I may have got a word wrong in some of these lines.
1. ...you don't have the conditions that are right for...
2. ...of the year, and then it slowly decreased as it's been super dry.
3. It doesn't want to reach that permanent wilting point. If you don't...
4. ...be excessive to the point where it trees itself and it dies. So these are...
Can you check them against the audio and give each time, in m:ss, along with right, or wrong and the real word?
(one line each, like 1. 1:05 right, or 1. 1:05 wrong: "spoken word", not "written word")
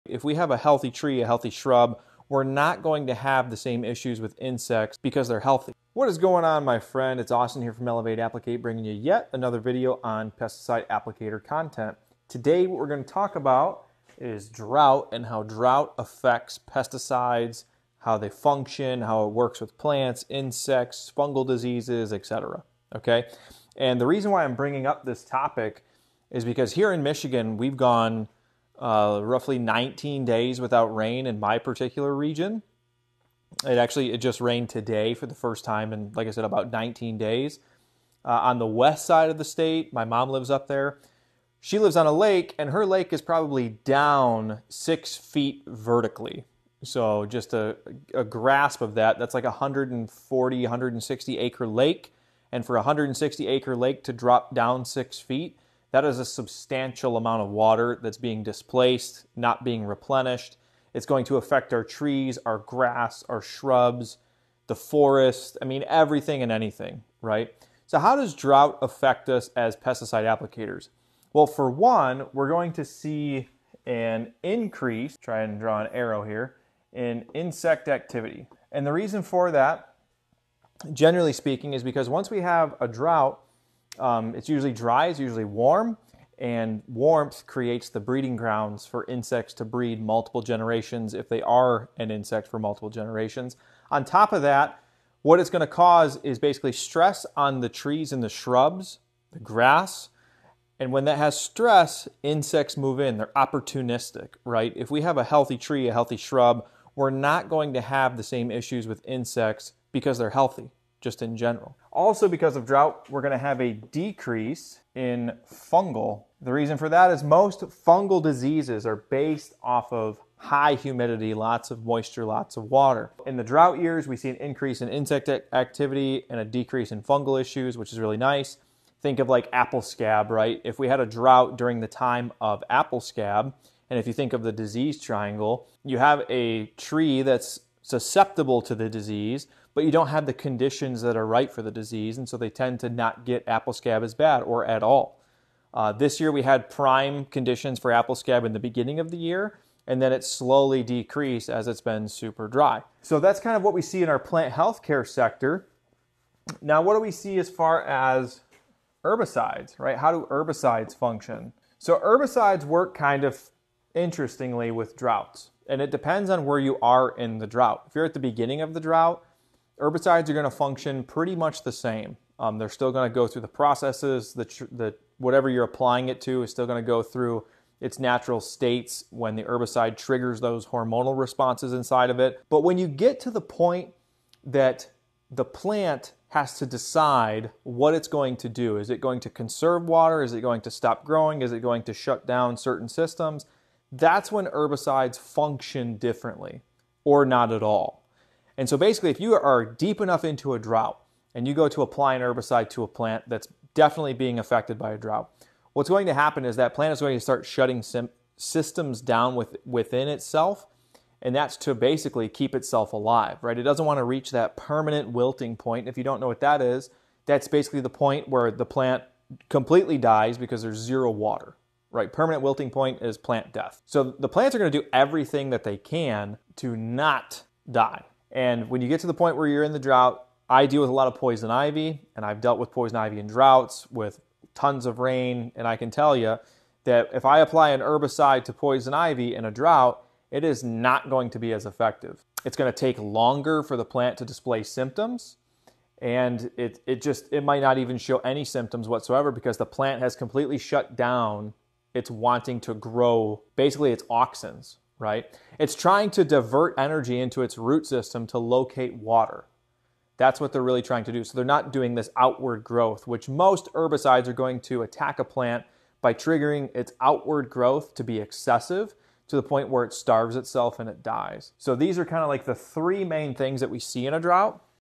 1. 2:19 right
2. 2:28 right
3. 3:33 right
4. 4:28 wrong: "starves", not "trees".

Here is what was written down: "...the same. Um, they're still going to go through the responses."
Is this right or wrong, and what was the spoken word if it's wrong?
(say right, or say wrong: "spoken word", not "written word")
wrong: "processes", not "responses".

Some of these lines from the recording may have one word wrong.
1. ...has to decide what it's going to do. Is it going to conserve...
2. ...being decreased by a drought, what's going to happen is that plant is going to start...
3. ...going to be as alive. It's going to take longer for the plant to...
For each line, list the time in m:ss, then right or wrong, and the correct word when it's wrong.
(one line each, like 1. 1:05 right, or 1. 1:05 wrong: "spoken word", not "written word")
1. 3:06 right
2. 3:24 wrong: "affected", not "decreased"
3. 4:01 wrong: "effective", not "alive".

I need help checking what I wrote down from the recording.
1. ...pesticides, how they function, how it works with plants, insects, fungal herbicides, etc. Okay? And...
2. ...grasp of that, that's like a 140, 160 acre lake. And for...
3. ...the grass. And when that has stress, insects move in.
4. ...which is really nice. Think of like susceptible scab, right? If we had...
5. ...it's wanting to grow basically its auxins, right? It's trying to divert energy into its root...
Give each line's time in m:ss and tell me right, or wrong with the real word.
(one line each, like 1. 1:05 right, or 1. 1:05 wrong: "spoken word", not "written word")
1. 0:16 wrong: "diseases", not "herbicides"
2. 0:48 right
3. 1:39 right
4. 2:07 wrong: "apple", not "susceptible"
5. 4:11 right.